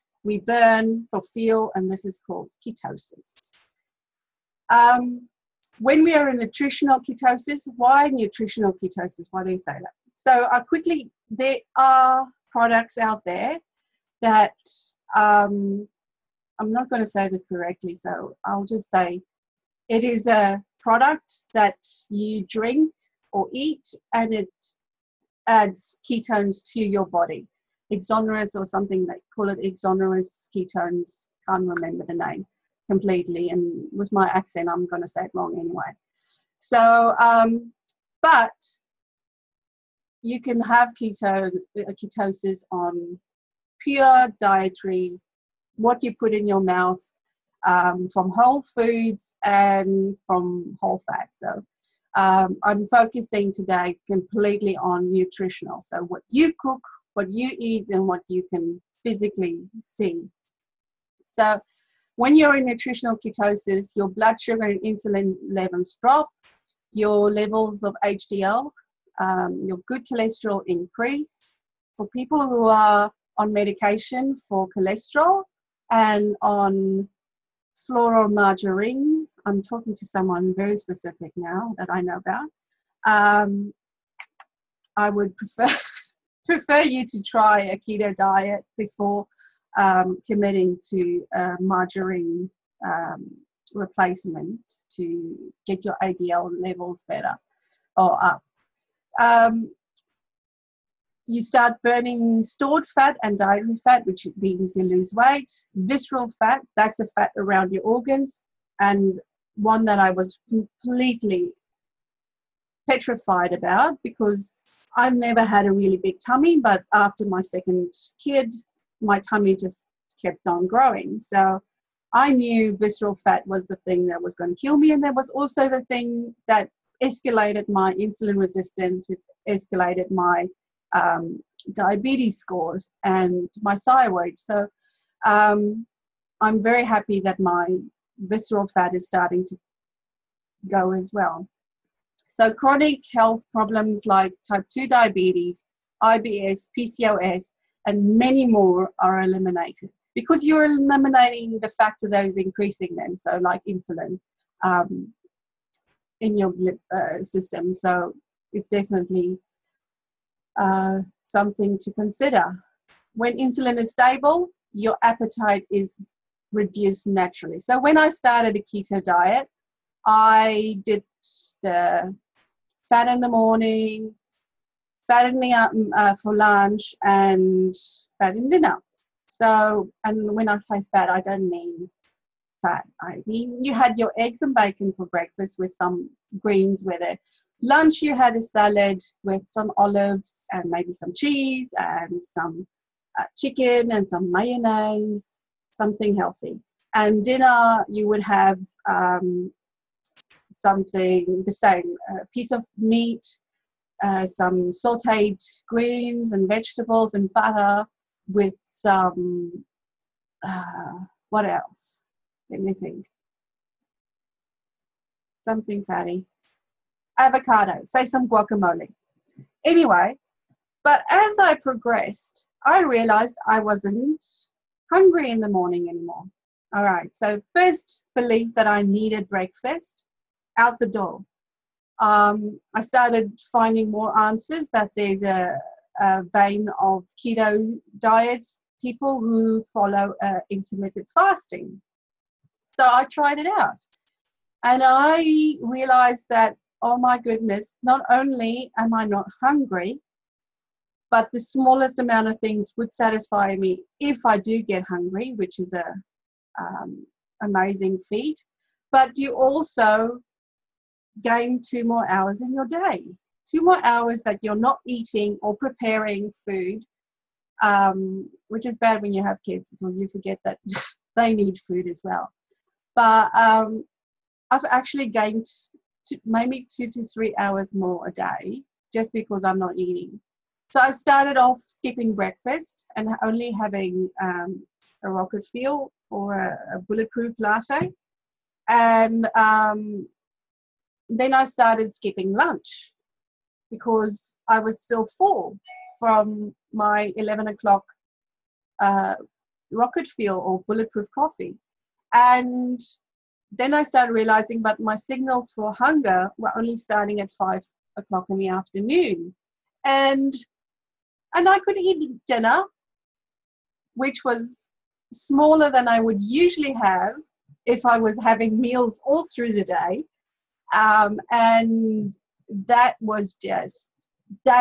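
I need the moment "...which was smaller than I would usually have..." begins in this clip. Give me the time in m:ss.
5:13.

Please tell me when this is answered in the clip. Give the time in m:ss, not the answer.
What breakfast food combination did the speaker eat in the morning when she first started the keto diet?
3:04.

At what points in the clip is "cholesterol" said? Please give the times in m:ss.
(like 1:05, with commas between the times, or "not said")
1:10, 1:14.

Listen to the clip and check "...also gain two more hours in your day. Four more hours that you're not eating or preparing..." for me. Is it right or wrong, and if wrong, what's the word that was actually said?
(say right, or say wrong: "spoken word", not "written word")
wrong: "Two", not "Four".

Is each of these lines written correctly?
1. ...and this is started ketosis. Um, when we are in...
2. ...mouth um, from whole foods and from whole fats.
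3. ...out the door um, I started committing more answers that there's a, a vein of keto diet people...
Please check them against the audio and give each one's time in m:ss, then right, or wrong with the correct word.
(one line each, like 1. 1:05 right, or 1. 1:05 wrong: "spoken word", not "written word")
1. 0:01 wrong: "called", not "started"
2. 0:46 right
3. 3:50 wrong: "finding", not "committing".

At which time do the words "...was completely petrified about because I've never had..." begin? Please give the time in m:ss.
1:50.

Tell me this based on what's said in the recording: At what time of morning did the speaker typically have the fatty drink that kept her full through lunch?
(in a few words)
11 o'clock.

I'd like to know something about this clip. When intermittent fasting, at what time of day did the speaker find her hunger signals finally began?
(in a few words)
5 o'clock.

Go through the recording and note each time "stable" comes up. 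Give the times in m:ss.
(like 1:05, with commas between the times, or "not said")
2:43.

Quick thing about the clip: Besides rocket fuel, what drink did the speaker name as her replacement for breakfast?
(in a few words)
bulletproof latte.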